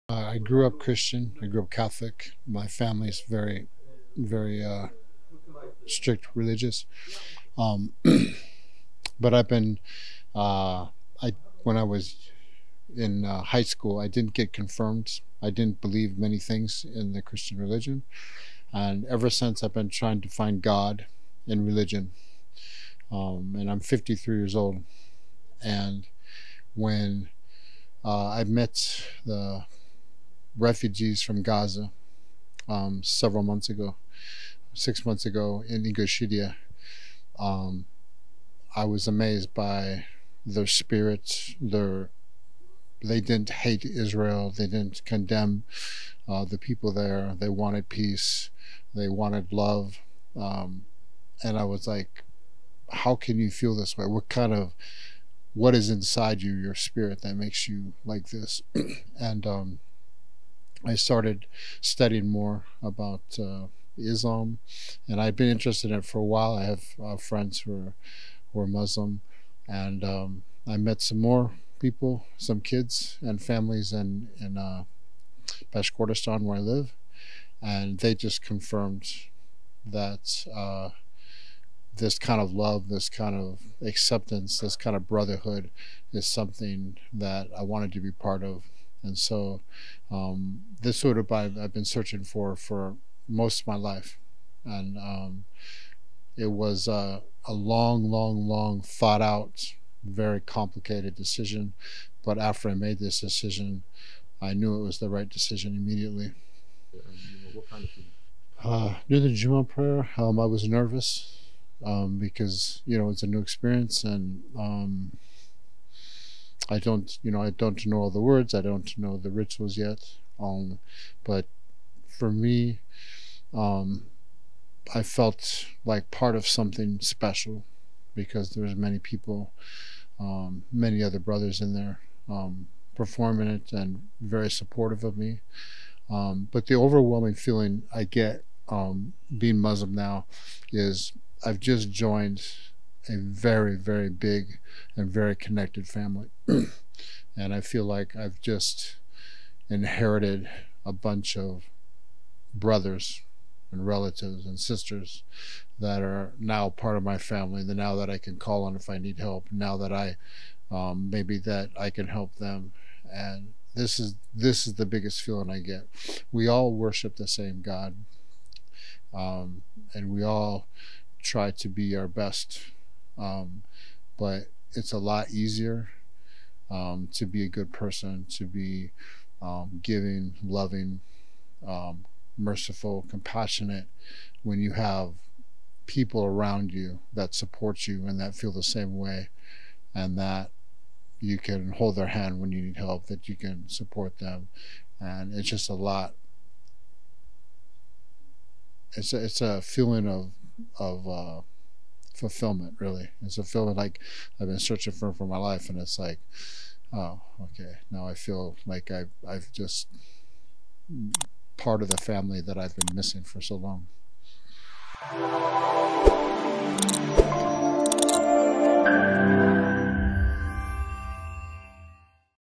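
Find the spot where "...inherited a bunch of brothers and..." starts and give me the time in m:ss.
2:29.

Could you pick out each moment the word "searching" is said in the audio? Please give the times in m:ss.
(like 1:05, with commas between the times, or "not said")
1:31, 3:24.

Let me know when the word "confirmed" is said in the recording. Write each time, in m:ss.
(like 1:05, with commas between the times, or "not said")
0:14, 1:18.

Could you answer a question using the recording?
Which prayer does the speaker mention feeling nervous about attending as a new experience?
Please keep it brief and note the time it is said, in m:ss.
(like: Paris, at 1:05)
Juma, at 1:49.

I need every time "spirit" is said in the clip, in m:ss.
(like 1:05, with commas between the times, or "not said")
0:40, 0:56.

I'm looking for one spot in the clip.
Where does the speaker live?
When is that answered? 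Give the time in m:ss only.
1:15.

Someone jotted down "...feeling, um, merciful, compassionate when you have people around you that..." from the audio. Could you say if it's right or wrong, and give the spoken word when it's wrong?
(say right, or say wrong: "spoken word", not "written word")
wrong: "loving", not "feeling".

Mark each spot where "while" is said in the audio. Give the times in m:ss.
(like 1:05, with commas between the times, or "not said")
1:06.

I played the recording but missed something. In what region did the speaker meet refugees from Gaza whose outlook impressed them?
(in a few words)
Ingushetia.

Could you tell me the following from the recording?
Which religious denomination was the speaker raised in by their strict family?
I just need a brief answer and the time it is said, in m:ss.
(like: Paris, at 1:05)
Catholic, at 0:01.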